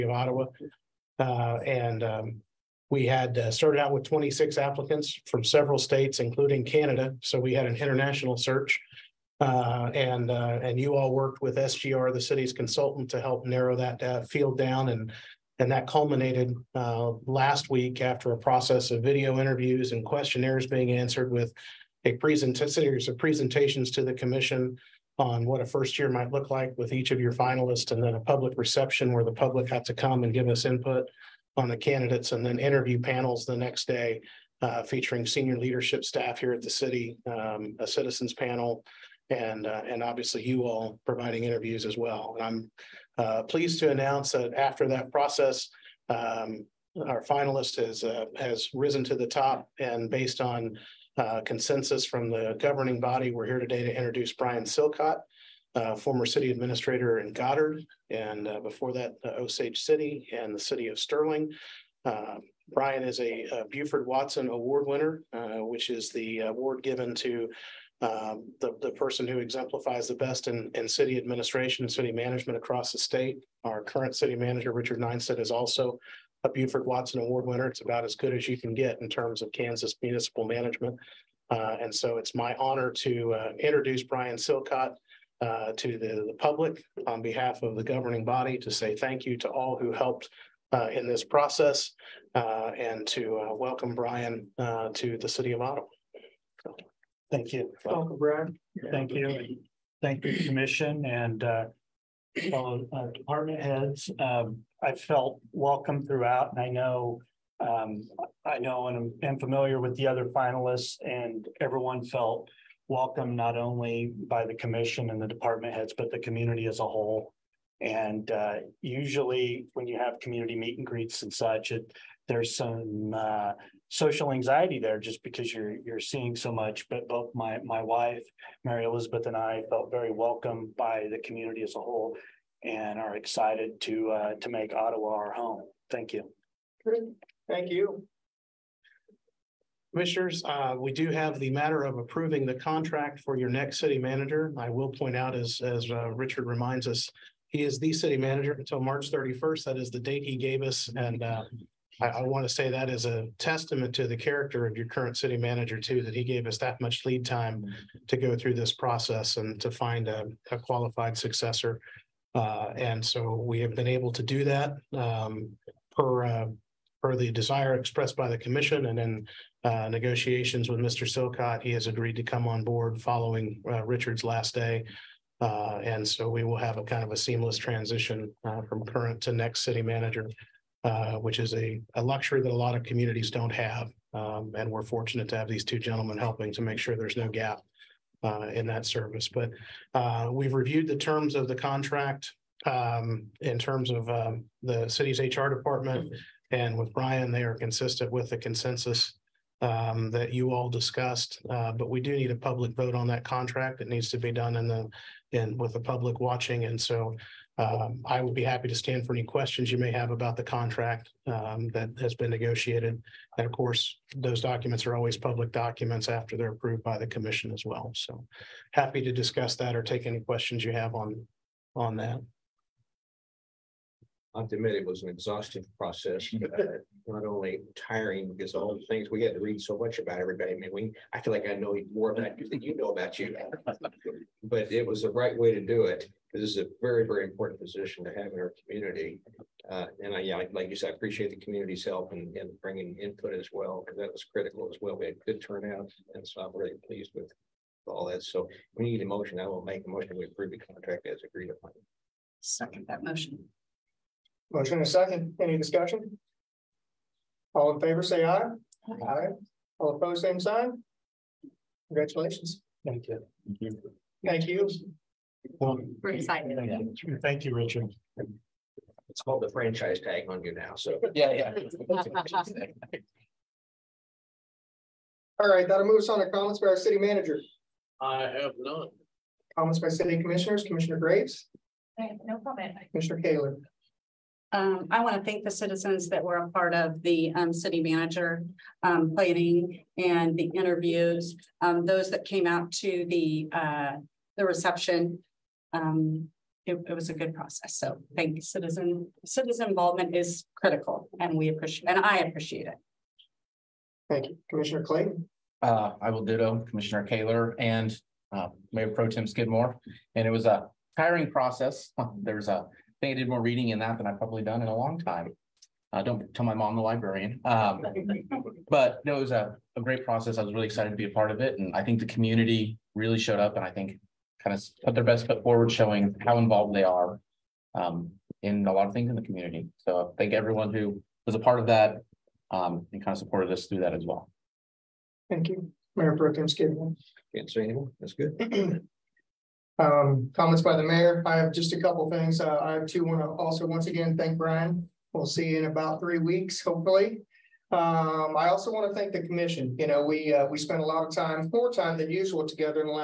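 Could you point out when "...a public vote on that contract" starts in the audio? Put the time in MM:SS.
03:22.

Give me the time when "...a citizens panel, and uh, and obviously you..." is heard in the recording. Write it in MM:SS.
00:37.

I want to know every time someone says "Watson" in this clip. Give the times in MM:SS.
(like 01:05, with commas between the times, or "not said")
01:04, 01:16.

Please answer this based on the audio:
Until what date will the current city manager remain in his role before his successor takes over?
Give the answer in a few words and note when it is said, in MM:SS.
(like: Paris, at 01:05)
March 31st, at 02:28.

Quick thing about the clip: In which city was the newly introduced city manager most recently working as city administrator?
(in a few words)
Goddard.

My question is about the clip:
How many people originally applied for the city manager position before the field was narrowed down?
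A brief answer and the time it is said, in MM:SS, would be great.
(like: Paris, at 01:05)
26, at 00:04.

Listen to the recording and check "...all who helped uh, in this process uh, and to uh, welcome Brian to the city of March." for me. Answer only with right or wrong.
wrong.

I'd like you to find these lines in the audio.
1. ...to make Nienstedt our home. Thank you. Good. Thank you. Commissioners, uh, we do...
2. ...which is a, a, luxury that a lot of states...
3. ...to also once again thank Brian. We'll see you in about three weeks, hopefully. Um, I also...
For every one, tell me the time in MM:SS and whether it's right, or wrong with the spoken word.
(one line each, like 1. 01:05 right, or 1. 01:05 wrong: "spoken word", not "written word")
1. 02:14 wrong: "Ottawa", not "Nienstedt"
2. 03:01 wrong: "communities", not "states"
3. 05:43 right.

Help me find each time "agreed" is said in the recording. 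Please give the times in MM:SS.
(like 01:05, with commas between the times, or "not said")
02:51, 04:11.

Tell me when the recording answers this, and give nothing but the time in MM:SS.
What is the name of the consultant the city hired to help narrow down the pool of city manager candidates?
00:11.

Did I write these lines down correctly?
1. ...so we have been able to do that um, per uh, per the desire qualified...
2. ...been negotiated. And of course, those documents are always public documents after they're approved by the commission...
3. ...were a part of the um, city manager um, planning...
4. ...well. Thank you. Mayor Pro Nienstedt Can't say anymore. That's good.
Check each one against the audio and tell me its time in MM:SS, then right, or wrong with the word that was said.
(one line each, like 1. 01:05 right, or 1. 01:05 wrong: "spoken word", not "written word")
1. 02:43 wrong: "expressed", not "qualified"
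2. 03:32 right
3. 04:46 right
4. 05:34 wrong: "Tem", not "Nienstedt".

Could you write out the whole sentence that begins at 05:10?
And it was a tiring process.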